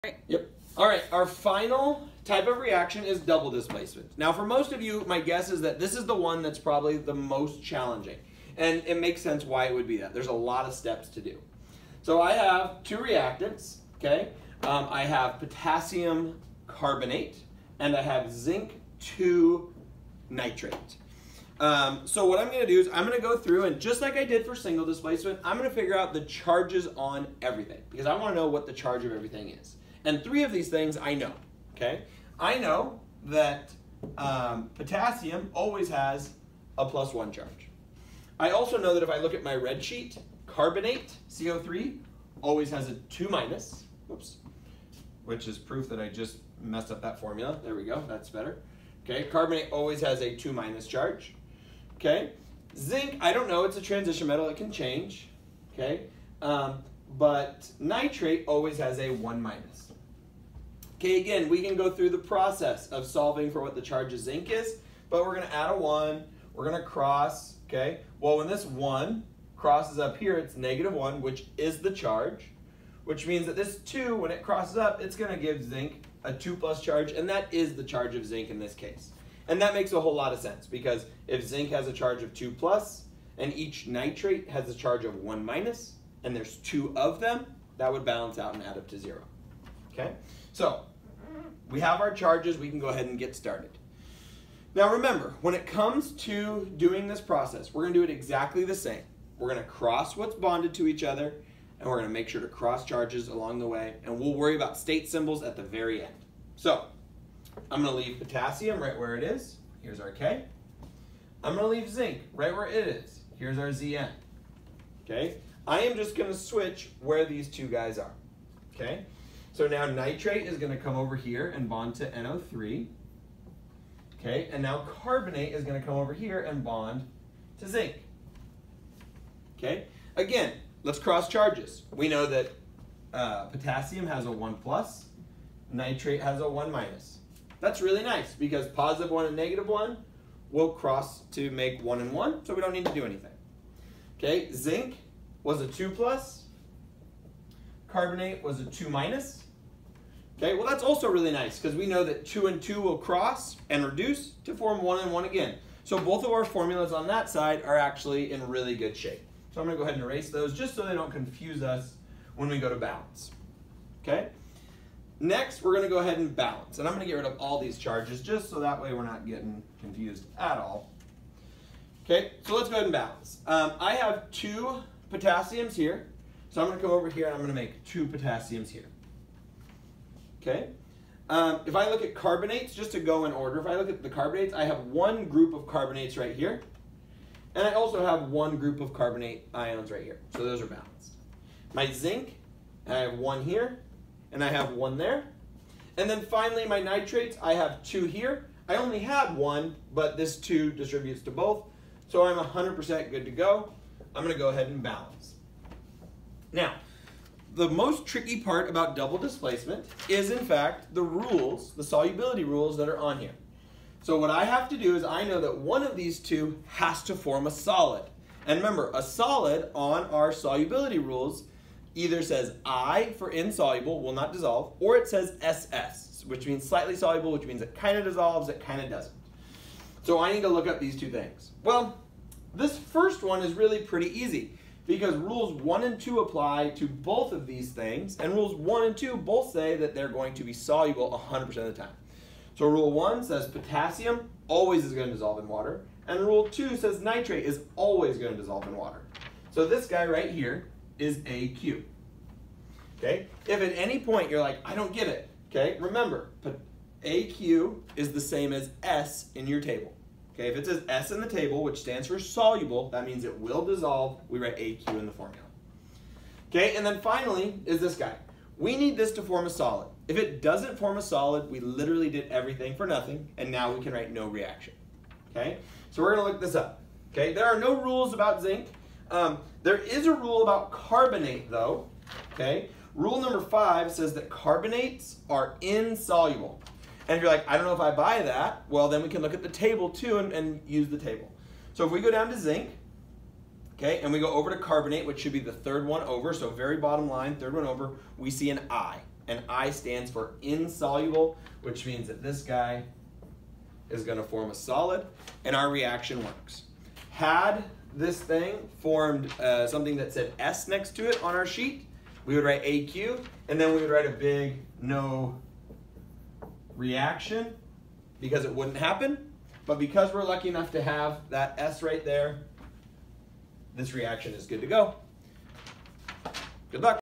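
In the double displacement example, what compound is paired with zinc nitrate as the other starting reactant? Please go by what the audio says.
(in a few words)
Potassium carbonate.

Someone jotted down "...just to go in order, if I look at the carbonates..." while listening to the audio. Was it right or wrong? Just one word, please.
right.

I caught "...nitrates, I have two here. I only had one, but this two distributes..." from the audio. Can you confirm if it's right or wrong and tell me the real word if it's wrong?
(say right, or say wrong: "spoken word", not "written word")
right.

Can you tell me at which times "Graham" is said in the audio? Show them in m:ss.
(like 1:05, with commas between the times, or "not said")
not said.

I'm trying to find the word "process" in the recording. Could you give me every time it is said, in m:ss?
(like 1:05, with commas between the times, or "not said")
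1:02, 1:37.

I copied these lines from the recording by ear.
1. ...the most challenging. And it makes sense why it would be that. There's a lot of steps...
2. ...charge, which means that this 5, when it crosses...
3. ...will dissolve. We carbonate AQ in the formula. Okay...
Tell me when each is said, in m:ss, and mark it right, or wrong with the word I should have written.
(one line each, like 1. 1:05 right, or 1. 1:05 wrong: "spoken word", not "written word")
1. 0:06 right
2. 1:11 wrong: "2", not "5"
3. 4:23 wrong: "write", not "carbonate".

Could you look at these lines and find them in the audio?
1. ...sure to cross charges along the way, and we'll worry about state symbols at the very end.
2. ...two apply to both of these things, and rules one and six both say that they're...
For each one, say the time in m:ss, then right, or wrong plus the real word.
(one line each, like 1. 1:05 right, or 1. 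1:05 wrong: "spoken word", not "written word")
1. 1:42 right
2. 3:55 wrong: "two", not "six".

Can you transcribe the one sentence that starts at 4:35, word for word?
Okay, so we're gonna look this up.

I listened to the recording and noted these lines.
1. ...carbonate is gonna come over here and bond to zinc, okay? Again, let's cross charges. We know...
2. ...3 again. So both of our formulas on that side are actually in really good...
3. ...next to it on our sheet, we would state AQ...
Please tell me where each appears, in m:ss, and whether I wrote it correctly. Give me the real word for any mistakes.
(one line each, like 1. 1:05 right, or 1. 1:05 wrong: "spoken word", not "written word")
1. 2:04 right
2. 2:35 wrong: "1", not "3"
3. 5:10 wrong: "write", not "state".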